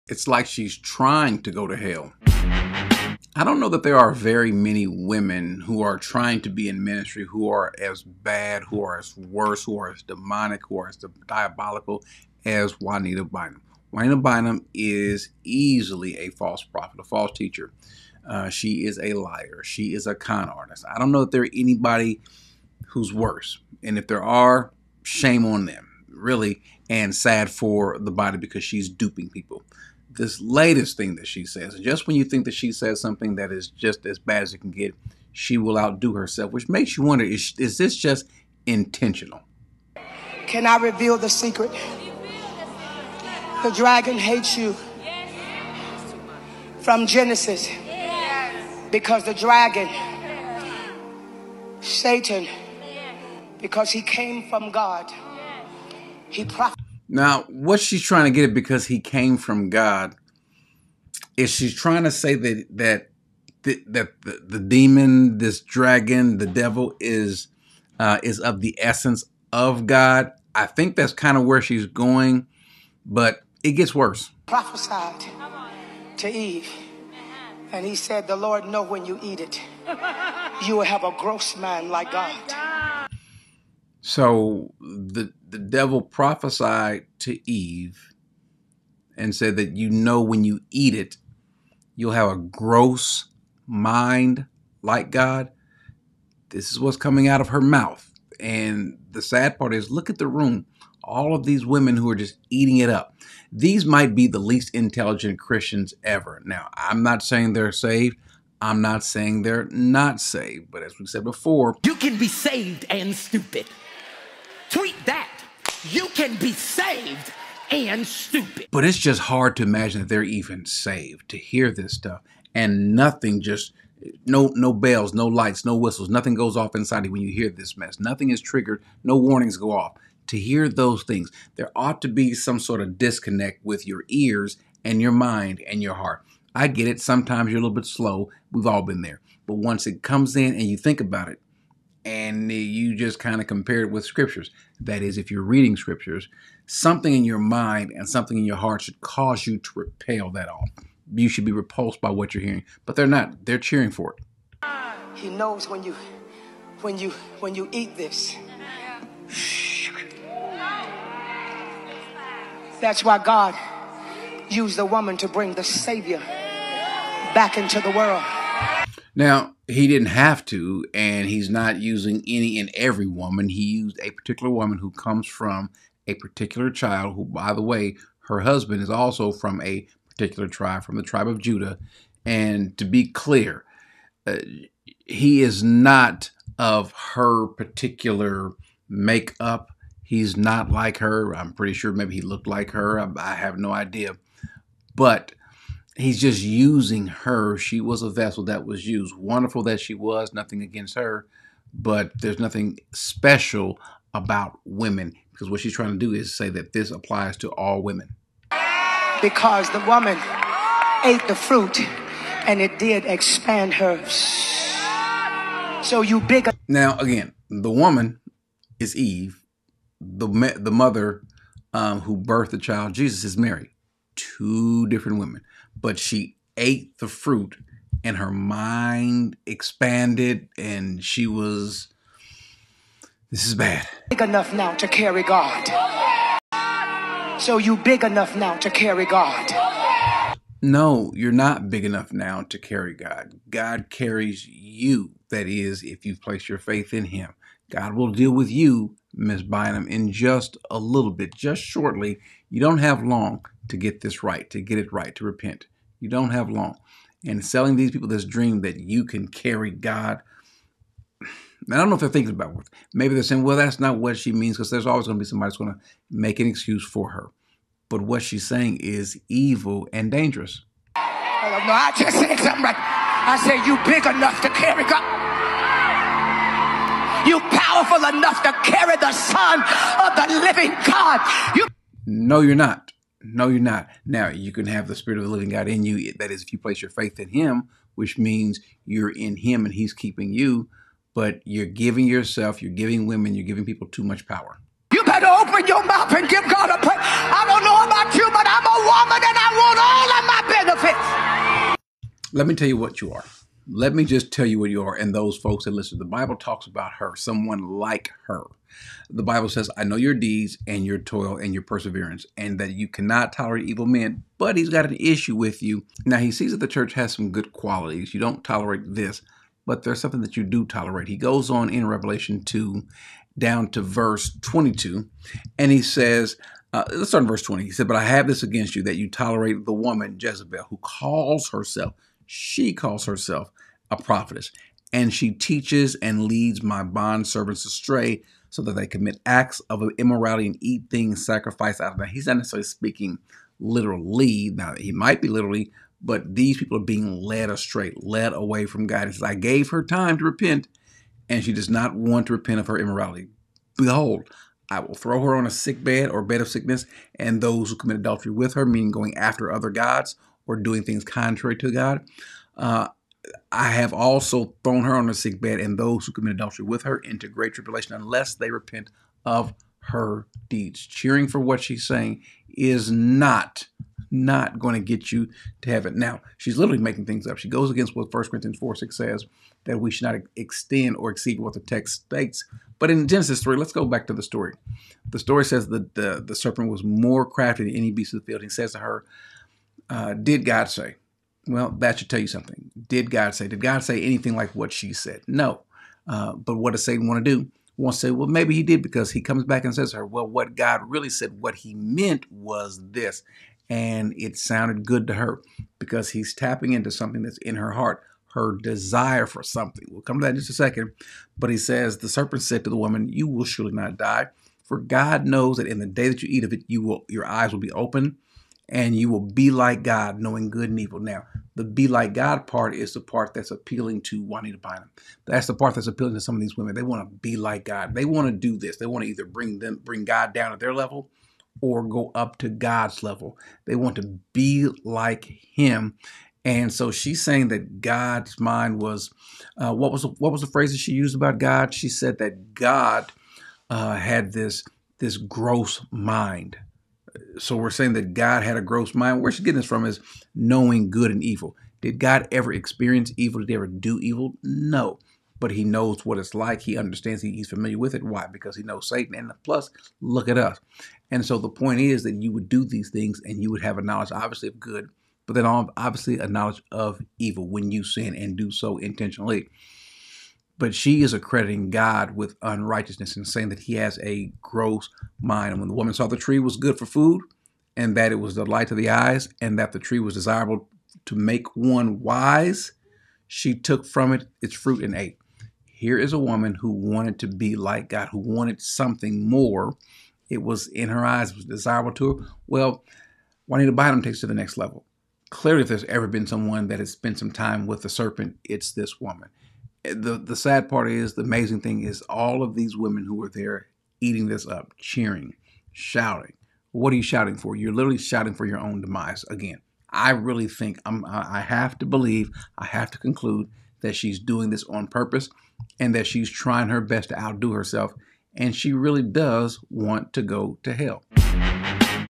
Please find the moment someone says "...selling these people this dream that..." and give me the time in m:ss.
4:17.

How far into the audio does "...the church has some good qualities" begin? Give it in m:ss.
5:16.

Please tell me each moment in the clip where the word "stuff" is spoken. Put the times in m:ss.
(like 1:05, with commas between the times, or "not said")
2:01.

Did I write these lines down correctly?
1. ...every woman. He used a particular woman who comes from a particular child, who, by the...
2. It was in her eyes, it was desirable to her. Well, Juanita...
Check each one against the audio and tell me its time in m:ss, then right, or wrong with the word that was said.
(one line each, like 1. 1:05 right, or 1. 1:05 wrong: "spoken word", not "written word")
1. 2:52 right
2. 8:10 right.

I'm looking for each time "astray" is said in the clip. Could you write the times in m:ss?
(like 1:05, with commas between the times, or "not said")
5:37, 5:47.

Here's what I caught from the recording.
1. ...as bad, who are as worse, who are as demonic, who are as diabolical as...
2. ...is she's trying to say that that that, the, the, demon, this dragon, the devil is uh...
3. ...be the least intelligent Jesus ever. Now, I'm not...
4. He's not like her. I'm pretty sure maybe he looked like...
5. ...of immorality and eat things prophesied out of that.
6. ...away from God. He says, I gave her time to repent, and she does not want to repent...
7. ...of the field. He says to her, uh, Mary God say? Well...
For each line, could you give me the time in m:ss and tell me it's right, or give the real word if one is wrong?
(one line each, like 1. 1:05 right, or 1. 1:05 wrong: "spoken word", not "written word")
1. 0:07 right
2. 1:01 right
3. 1:44 wrong: "Christians", not "Jesus"
4. 3:10 right
5. 5:39 wrong: "sacrificed", not "prophesied"
6. 5:48 right
7. 6:28 wrong: "Did", not "Mary".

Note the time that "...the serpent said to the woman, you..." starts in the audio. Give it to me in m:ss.
6:51.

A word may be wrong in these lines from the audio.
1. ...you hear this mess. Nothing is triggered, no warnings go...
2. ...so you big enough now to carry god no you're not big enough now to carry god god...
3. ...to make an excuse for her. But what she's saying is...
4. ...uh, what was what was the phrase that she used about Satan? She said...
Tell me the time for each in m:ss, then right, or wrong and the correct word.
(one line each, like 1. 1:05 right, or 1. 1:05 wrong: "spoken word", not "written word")
1. 2:07 right
2. 3:57 right
3. 4:25 right
4. 7:19 wrong: "God", not "Satan".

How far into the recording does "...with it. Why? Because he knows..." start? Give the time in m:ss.
7:37.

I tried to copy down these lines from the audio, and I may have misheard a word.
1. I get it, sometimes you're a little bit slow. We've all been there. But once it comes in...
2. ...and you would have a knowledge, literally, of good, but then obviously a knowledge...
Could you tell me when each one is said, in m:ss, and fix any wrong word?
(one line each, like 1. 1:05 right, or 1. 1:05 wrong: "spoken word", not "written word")
1. 2:16 right
2. 7:43 wrong: "obviously", not "literally".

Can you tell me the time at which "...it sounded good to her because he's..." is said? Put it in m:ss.
6:44.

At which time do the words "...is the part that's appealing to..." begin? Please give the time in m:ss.
7:02.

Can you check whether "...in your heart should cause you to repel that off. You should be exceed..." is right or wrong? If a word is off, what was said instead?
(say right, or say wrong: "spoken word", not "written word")
wrong: "repulsed", not "exceed".